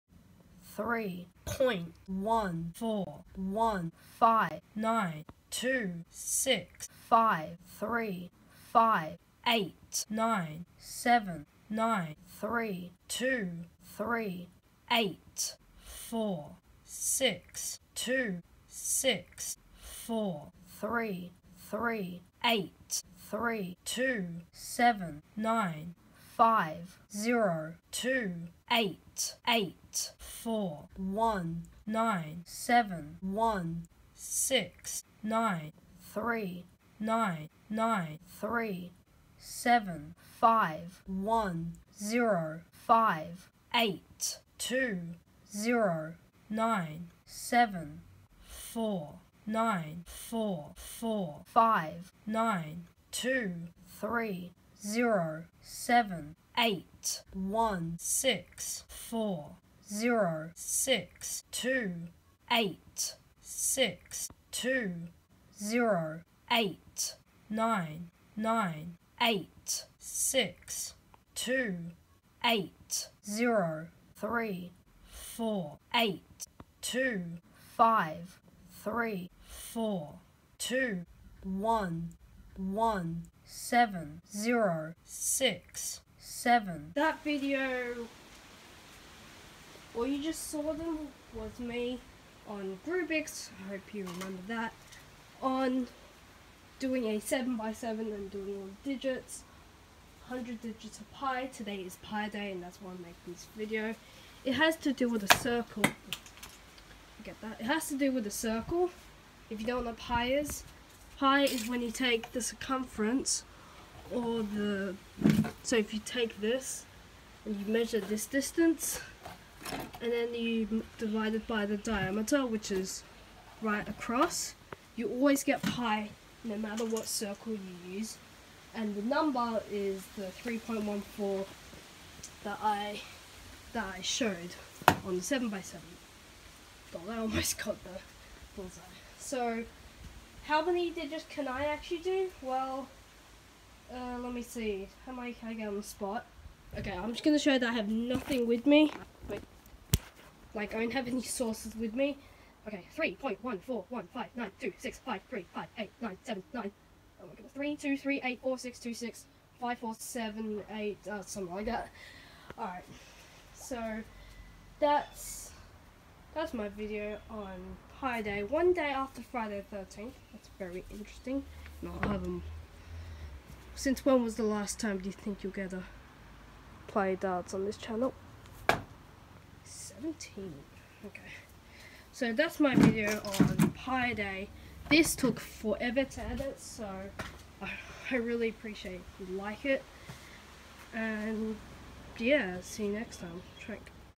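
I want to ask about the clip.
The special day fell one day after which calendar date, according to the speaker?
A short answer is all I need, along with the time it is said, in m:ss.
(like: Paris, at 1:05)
Friday the 13th, at 2:49.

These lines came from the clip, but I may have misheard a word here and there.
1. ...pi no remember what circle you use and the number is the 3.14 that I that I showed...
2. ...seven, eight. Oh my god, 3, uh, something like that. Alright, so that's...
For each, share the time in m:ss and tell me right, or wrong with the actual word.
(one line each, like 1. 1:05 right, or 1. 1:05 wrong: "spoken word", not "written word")
1. 2:05 wrong: "matter", not "remember"
2. 2:36 wrong: "nine", not "eight".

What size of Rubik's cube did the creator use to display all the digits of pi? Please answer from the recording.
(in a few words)
7x7.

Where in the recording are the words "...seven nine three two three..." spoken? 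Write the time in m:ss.
0:10.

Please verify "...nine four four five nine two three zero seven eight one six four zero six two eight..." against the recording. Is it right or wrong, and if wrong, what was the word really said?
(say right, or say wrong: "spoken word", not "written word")
right.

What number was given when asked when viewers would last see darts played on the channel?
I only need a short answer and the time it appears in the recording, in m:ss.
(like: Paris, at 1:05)
17, at 2:59.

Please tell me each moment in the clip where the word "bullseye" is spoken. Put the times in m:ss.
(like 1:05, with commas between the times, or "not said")
2:18.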